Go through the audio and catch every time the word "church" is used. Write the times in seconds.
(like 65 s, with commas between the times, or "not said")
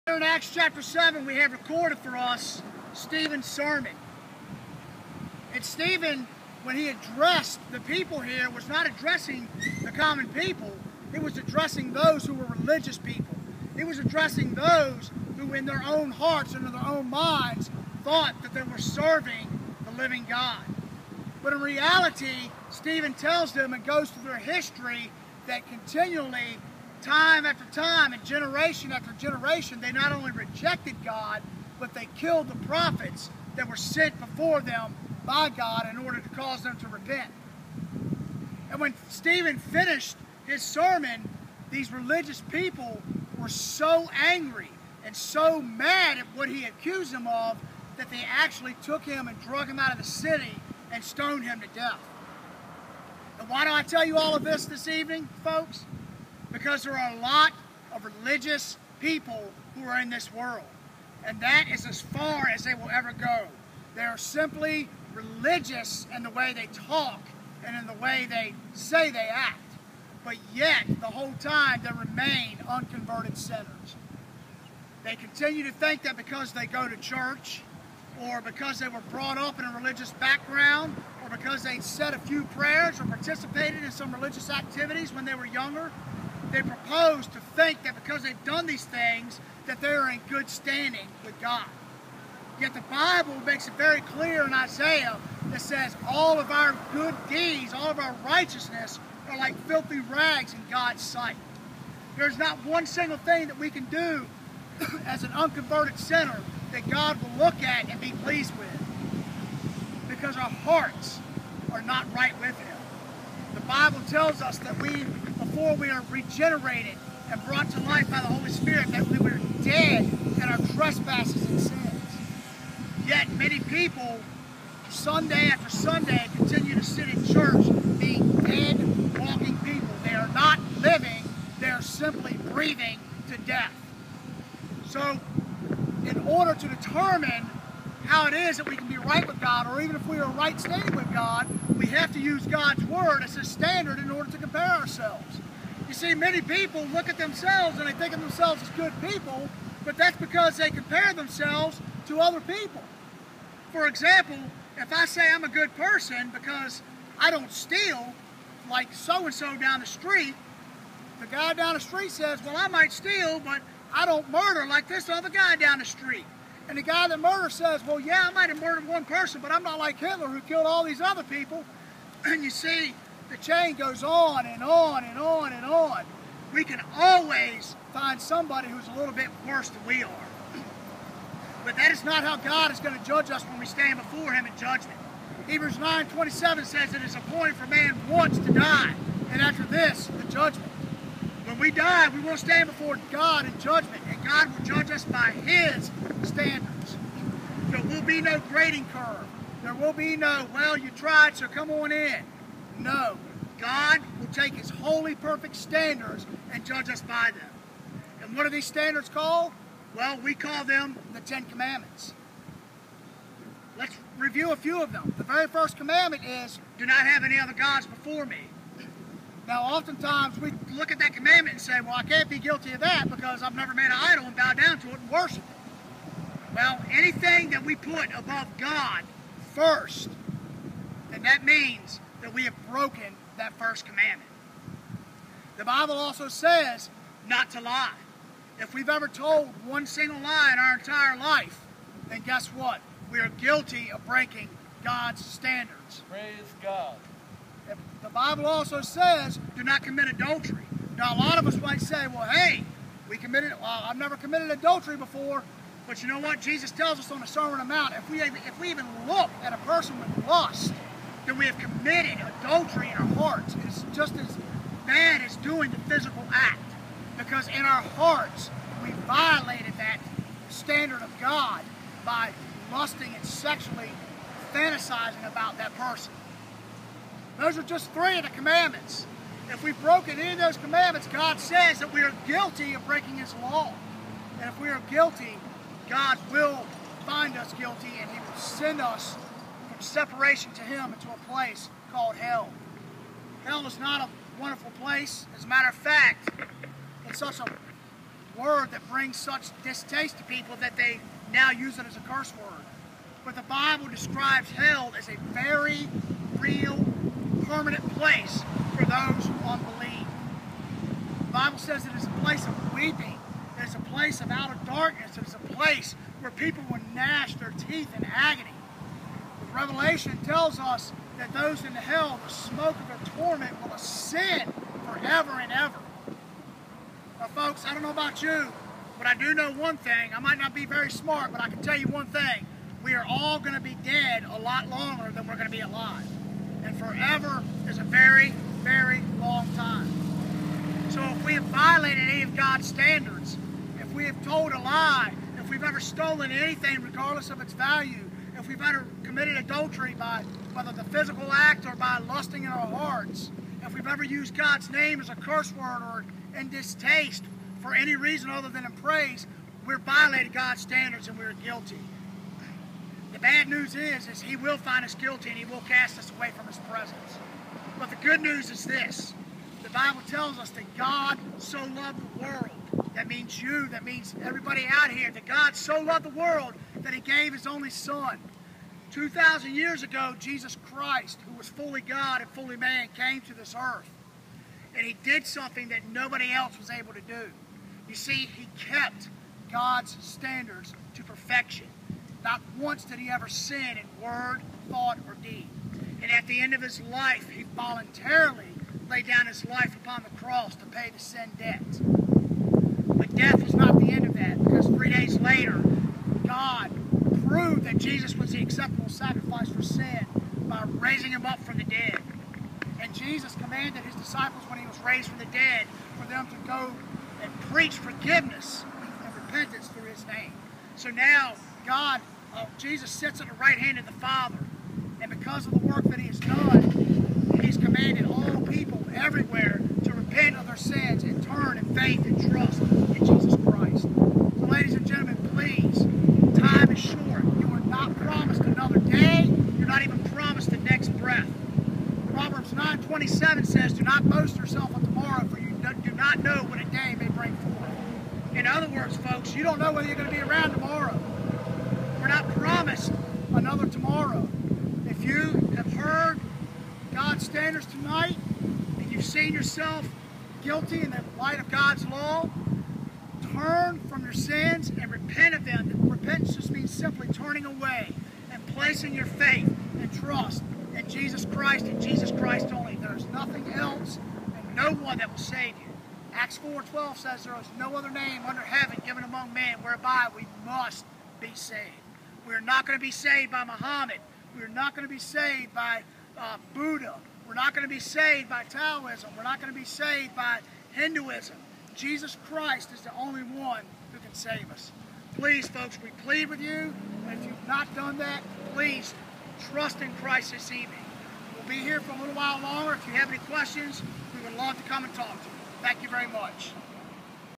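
76 s, 127 s.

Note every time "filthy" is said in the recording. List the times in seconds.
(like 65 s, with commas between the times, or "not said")
99 s.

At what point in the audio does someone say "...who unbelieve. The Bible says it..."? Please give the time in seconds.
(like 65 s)
309 s.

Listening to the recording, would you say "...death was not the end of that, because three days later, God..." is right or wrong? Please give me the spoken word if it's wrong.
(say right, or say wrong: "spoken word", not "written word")
right.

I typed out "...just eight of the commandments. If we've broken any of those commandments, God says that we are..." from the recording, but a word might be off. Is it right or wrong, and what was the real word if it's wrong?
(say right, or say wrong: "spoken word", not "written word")
wrong: "three", not "eight".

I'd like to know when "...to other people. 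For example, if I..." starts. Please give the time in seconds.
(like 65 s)
152 s.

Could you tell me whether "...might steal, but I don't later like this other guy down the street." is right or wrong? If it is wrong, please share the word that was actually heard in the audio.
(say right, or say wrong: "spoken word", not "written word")
wrong: "murder", not "later".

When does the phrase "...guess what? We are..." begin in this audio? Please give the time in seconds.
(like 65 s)
242 s.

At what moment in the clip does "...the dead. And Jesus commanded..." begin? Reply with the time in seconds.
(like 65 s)
411 s.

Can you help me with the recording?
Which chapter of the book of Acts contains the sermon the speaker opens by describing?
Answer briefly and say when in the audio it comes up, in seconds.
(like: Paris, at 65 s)
7, at 0 s.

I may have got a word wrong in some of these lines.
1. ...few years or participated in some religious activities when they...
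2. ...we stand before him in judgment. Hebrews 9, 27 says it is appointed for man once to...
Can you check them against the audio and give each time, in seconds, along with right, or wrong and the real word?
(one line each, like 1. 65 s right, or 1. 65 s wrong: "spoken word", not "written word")
1. 82 s wrong: "prayers", not "years"
2. 183 s right.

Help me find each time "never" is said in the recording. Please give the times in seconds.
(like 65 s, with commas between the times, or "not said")
223 s, 253 s.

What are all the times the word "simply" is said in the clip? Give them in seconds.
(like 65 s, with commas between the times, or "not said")
64 s, 131 s, 466 s.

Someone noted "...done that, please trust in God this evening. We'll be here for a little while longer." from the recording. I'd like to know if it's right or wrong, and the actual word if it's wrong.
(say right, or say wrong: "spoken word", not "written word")
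wrong: "Christ", not "God".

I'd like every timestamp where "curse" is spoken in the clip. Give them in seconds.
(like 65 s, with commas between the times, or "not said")
302 s, 355 s.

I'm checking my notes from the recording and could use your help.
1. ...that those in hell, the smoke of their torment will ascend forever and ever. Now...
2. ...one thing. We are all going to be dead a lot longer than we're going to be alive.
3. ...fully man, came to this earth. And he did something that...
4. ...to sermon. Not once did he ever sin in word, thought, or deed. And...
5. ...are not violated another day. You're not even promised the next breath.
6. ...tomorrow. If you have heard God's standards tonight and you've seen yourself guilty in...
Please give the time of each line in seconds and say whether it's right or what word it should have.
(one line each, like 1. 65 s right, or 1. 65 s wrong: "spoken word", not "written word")
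1. 321 s right
2. 331 s right
3. 382 s right
4. 390 s wrong: "perfection", not "sermon"
5. 437 s wrong: "promised", not "violated"
6. 453 s right.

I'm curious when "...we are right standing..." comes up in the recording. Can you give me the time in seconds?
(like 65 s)
140 s.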